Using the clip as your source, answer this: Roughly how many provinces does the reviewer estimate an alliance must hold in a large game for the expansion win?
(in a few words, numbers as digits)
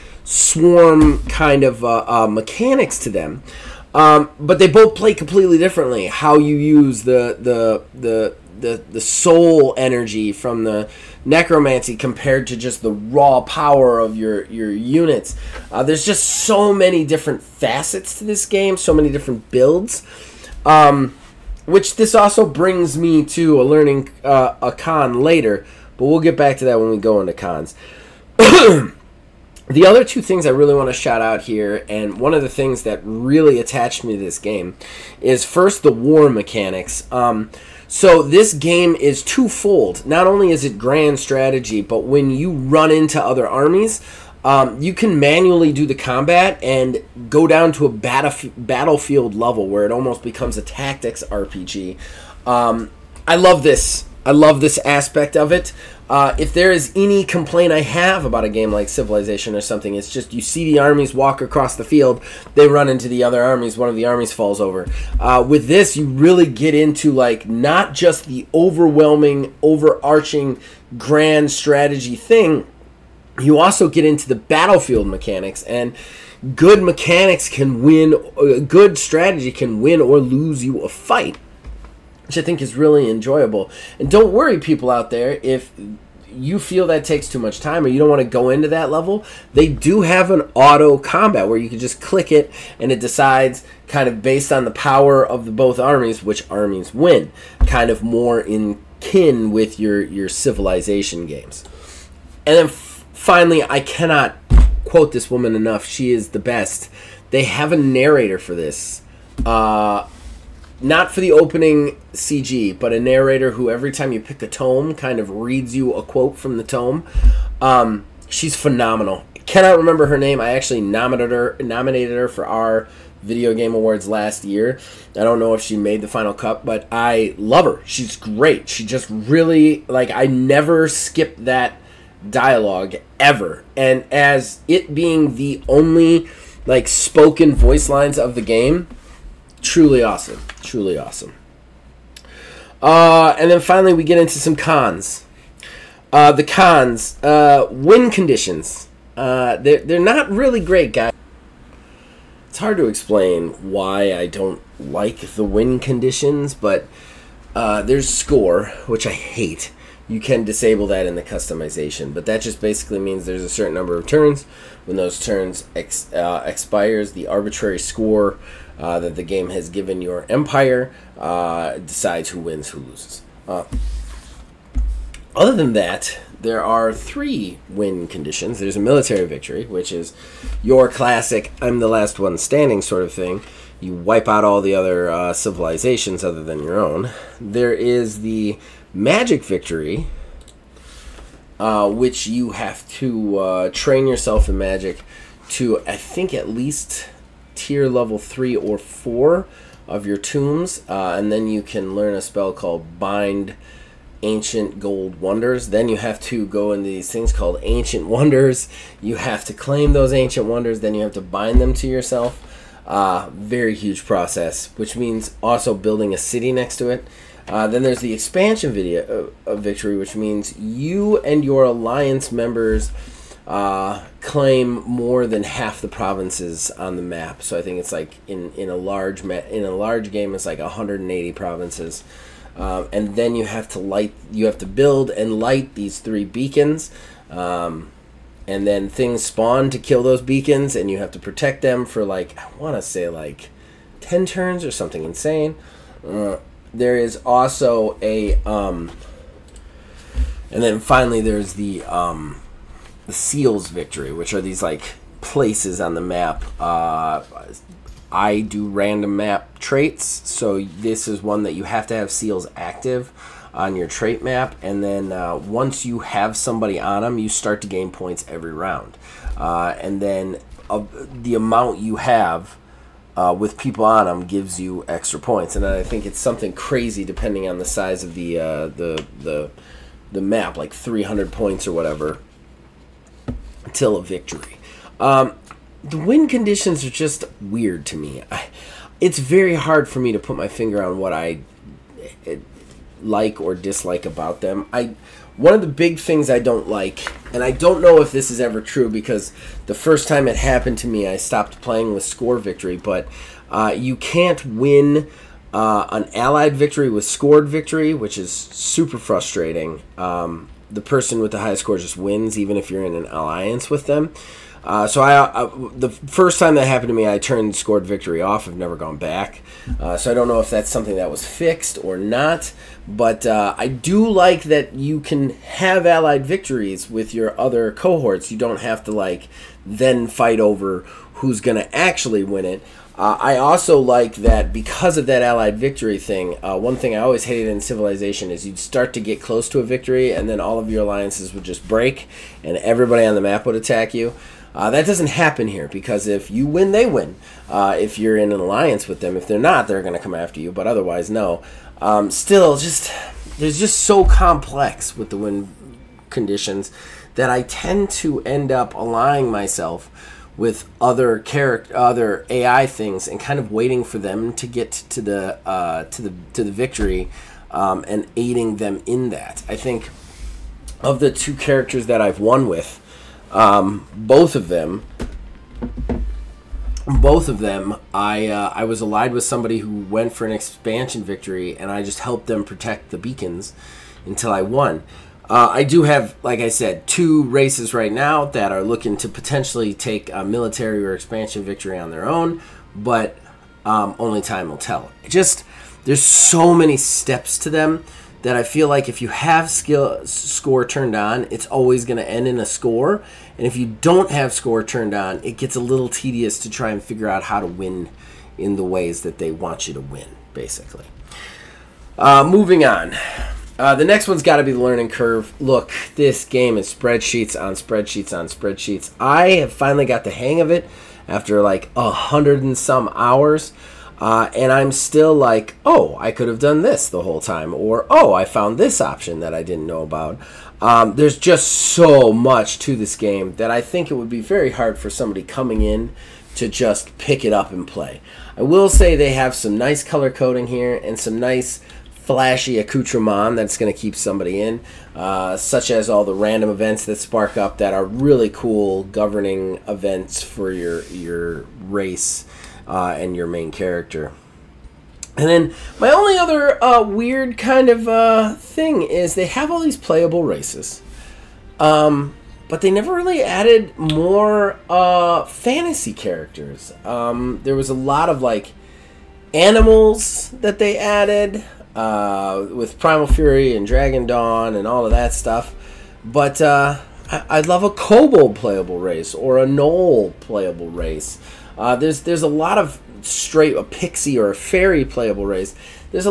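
180.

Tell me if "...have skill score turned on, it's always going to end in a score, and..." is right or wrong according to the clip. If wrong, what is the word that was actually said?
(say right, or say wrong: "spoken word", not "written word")
right.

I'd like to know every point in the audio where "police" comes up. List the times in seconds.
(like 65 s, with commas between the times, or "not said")
not said.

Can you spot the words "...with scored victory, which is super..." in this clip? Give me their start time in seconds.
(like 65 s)
306 s.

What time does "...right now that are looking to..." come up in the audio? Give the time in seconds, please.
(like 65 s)
387 s.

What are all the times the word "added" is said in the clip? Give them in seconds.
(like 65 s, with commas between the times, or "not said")
463 s, 470 s.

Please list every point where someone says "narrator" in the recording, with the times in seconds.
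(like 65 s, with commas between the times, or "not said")
107 s, 113 s.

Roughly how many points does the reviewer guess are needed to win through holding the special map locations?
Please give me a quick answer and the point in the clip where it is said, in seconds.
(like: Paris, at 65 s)
300, at 280 s.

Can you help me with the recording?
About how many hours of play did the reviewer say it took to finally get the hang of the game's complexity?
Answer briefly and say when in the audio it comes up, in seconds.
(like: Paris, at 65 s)
a hundred and some, at 421 s.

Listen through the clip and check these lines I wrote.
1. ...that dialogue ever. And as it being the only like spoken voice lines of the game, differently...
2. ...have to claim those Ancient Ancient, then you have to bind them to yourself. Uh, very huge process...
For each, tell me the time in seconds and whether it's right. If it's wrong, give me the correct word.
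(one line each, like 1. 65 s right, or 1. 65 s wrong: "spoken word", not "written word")
1. 131 s wrong: "truly", not "differently"
2. 209 s wrong: "Wonders", not "Ancient".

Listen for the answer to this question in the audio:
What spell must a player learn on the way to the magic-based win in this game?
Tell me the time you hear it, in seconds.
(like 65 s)
202 s.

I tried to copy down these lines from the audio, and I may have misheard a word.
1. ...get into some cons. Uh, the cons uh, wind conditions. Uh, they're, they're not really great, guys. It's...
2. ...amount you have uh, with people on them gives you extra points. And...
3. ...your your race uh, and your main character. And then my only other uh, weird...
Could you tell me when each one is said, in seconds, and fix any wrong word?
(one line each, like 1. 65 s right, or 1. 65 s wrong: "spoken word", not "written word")
1. 144 s right
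2. 271 s right
3. 450 s right.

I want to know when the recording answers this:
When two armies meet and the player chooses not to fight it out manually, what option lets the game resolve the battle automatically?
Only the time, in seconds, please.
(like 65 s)
90 s.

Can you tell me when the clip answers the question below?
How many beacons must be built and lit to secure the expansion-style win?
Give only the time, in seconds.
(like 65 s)
235 s.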